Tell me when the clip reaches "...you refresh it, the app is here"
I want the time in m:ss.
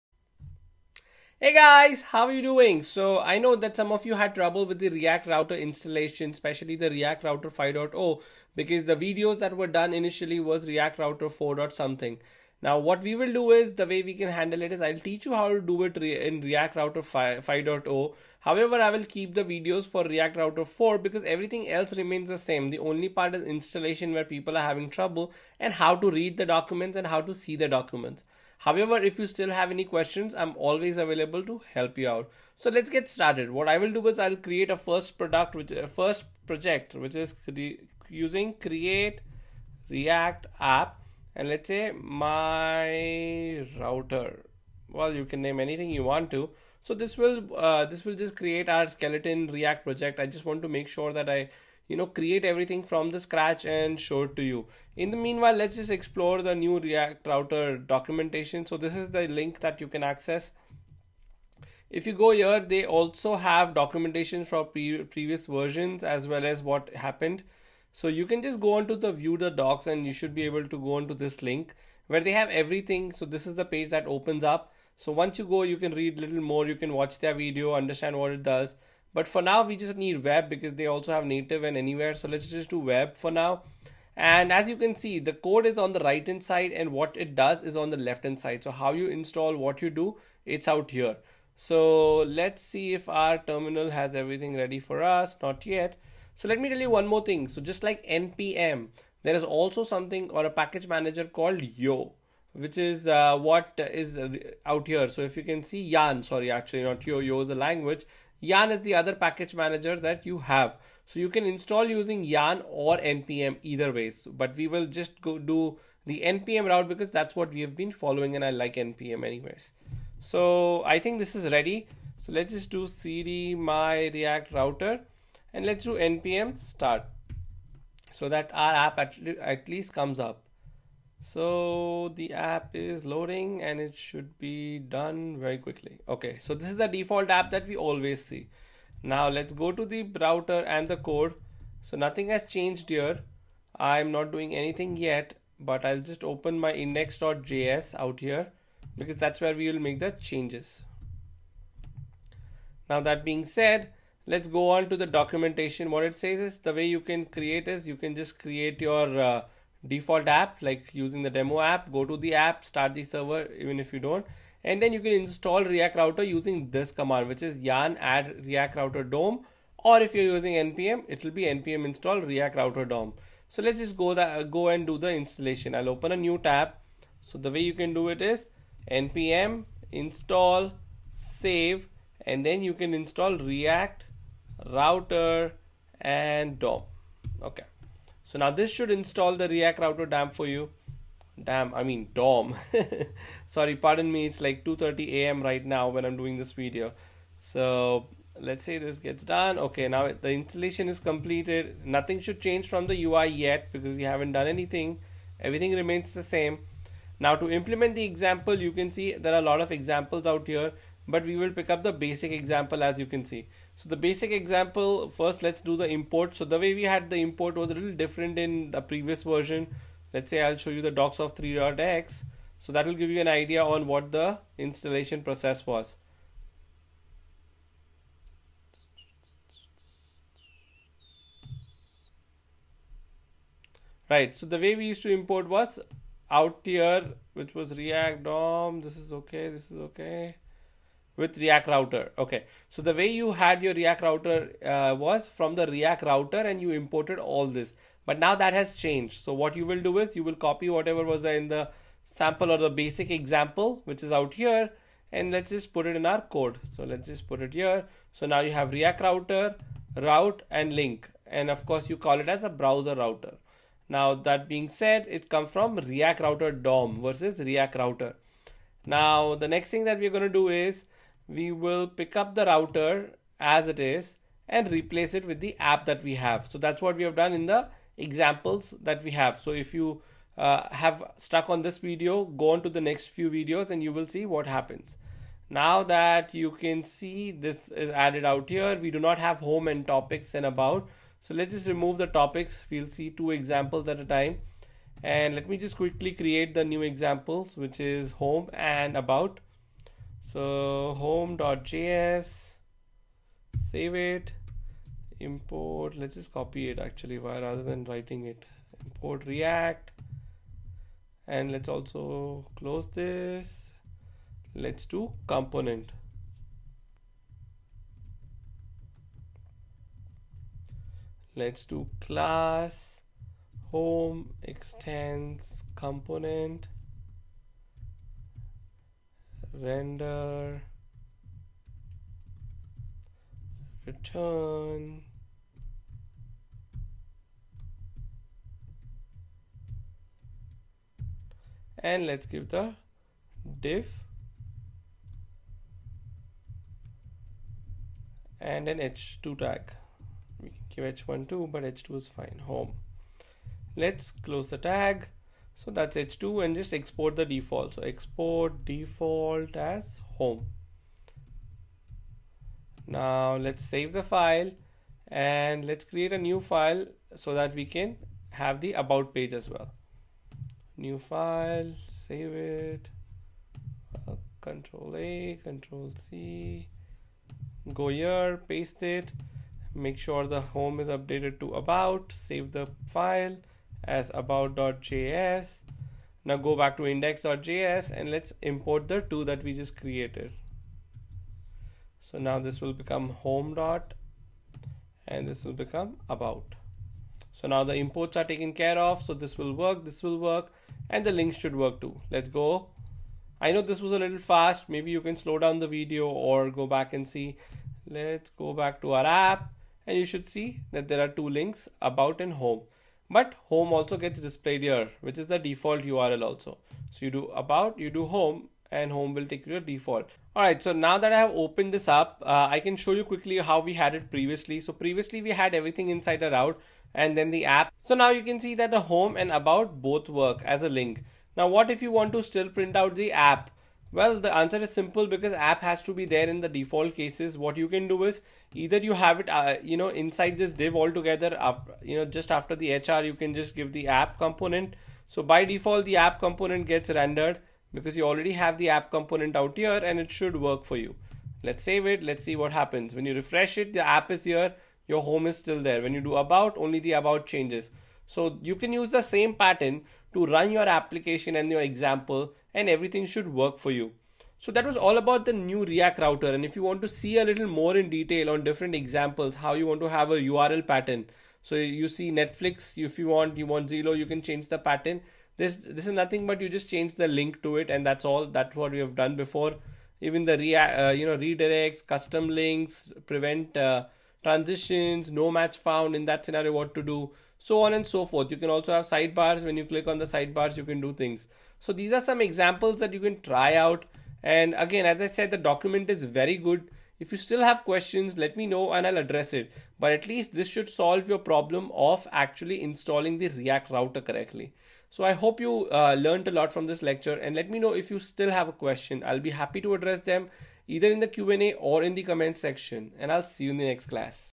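7:33.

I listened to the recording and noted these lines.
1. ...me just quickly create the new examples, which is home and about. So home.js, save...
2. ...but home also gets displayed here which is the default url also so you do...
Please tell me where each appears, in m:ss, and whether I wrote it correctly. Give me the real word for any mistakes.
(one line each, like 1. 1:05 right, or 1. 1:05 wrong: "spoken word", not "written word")
1. 4:55 right
2. 6:53 right.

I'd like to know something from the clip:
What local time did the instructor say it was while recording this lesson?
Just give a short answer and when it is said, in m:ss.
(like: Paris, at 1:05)
2:30 a.m., at 3:14.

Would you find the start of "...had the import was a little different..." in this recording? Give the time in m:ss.
3:36.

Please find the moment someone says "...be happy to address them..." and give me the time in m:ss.
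8:29.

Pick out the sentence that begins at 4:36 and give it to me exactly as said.
So that's what we have done in the examples that we have.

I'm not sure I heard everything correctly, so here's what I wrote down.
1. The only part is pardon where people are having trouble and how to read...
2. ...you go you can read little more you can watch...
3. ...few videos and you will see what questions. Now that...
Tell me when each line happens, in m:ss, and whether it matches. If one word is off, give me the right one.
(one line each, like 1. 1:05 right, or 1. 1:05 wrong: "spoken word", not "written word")
1. 0:22 wrong: "installation", not "pardon"
2. 1:15 right
3. 4:43 wrong: "happens", not "questions".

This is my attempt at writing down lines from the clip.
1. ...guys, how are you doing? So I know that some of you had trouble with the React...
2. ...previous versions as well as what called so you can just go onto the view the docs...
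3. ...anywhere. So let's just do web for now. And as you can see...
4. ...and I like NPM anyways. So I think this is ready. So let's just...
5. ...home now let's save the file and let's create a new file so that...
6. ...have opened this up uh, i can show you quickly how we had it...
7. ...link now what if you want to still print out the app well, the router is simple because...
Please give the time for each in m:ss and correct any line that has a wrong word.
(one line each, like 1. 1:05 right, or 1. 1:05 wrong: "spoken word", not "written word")
1. 0:01 right
2. 1:05 wrong: "happened", not "called"
3. 1:21 right
4. 1:58 right
5. 6:00 right
6. 7:01 right
7. 7:10 wrong: "answer", not "router".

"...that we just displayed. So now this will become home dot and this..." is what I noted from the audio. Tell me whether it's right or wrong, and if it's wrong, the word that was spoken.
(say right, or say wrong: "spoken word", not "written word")
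wrong: "created", not "displayed".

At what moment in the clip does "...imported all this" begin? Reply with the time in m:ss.
4:06.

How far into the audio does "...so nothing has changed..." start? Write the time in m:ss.
2:21.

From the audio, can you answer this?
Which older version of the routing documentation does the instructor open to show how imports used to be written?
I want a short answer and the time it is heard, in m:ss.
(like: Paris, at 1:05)
3.x, at 3:41.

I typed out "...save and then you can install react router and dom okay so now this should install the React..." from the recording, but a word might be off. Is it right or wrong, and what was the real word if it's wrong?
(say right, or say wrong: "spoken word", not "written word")
right.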